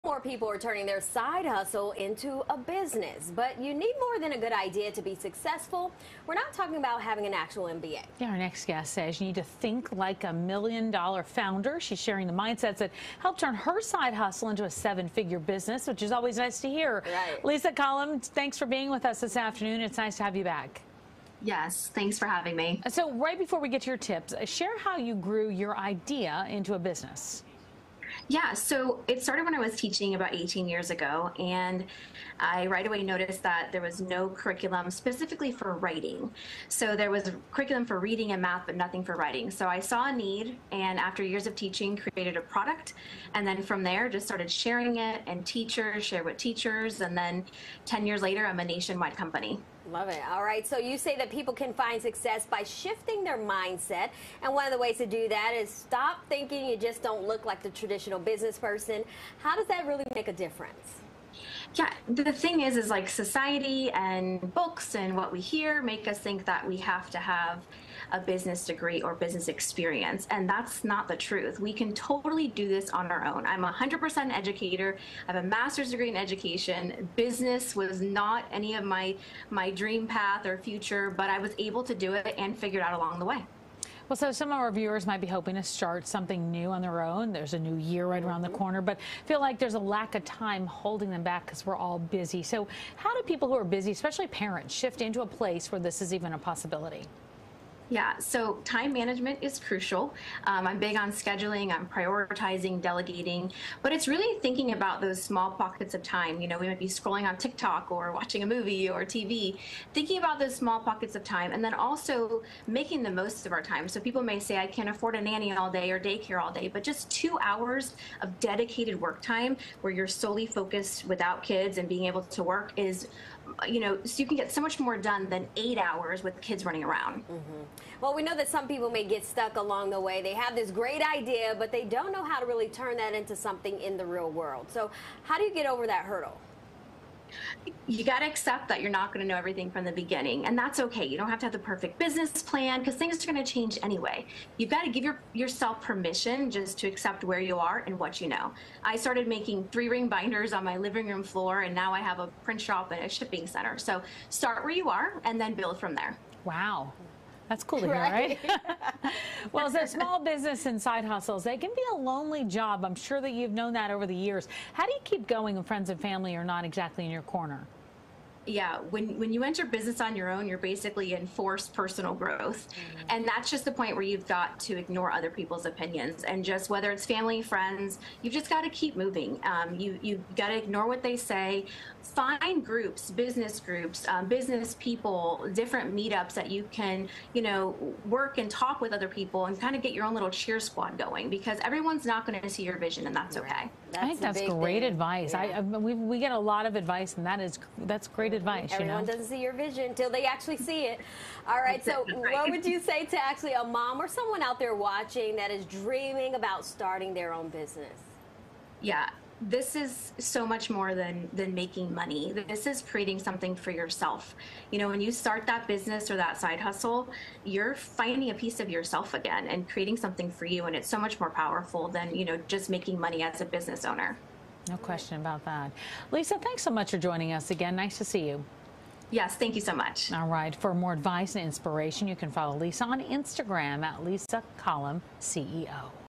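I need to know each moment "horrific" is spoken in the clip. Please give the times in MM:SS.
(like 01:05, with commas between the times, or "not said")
not said.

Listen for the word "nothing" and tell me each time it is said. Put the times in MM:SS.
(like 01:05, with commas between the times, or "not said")
00:38.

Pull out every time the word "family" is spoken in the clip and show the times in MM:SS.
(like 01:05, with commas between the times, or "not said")
02:45, 02:57.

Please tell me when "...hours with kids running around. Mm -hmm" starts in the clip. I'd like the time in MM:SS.
02:05.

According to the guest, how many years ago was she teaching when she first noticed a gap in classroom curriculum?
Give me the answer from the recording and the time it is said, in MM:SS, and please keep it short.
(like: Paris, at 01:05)
18 years, at 00:30.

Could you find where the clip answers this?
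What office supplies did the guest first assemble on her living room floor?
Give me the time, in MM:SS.
02:29.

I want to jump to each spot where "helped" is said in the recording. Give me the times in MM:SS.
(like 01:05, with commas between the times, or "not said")
00:13.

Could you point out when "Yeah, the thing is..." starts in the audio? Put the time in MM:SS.
01:01.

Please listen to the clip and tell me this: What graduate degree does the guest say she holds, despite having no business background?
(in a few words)
master's degree in education.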